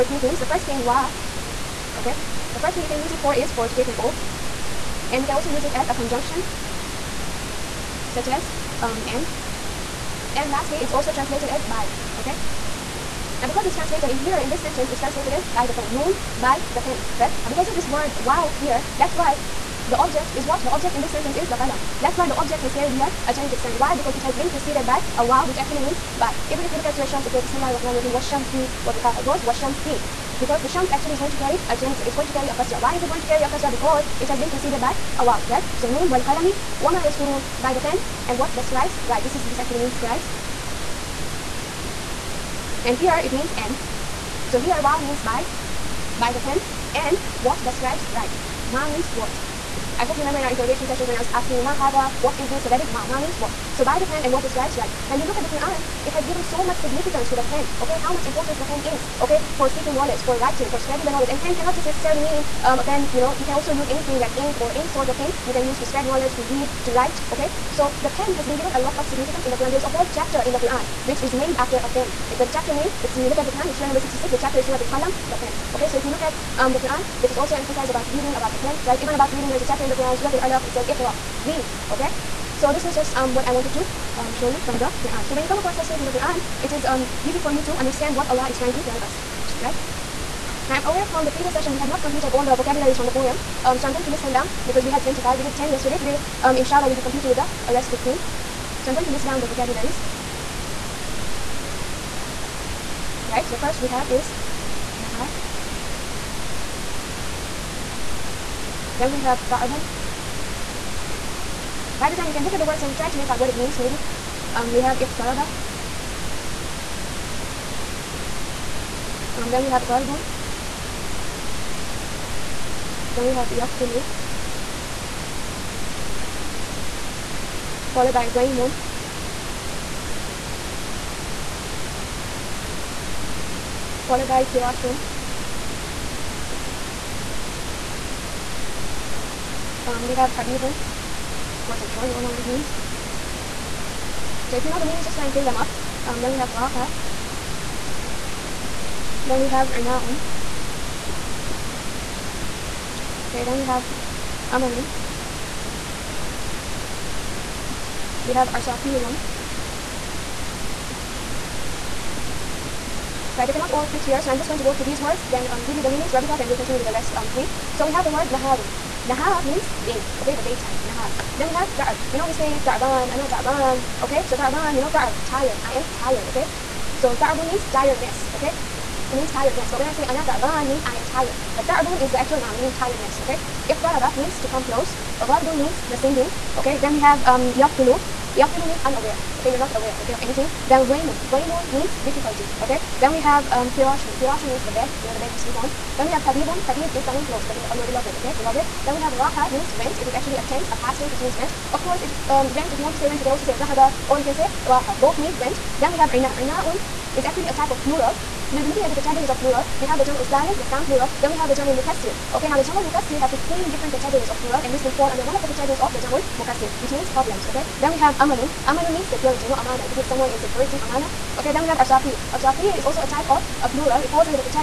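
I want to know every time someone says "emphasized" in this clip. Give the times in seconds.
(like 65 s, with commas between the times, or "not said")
77 s.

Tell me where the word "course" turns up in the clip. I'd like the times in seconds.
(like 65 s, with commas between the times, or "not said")
141 s, 201 s.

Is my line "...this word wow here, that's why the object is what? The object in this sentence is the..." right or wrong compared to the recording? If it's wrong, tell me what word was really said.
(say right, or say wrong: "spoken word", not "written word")
right.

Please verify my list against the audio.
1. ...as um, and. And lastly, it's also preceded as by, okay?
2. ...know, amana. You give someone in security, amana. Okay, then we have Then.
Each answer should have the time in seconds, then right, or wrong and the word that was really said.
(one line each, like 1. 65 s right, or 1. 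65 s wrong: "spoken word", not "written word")
1. 8 s wrong: "translated", not "preceded"
2. 219 s wrong: "Arsafir", not "Then".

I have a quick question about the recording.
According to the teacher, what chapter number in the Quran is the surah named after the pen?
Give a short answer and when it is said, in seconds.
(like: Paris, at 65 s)
66, at 73 s.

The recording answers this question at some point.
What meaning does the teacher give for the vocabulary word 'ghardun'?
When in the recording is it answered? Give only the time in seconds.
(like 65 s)
185 s.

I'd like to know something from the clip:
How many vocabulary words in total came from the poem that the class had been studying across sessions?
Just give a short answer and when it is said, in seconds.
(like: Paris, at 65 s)
25, at 94 s.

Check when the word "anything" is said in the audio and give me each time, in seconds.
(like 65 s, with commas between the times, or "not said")
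63 s, 190 s.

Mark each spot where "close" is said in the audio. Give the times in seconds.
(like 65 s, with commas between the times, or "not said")
184 s, 197 s.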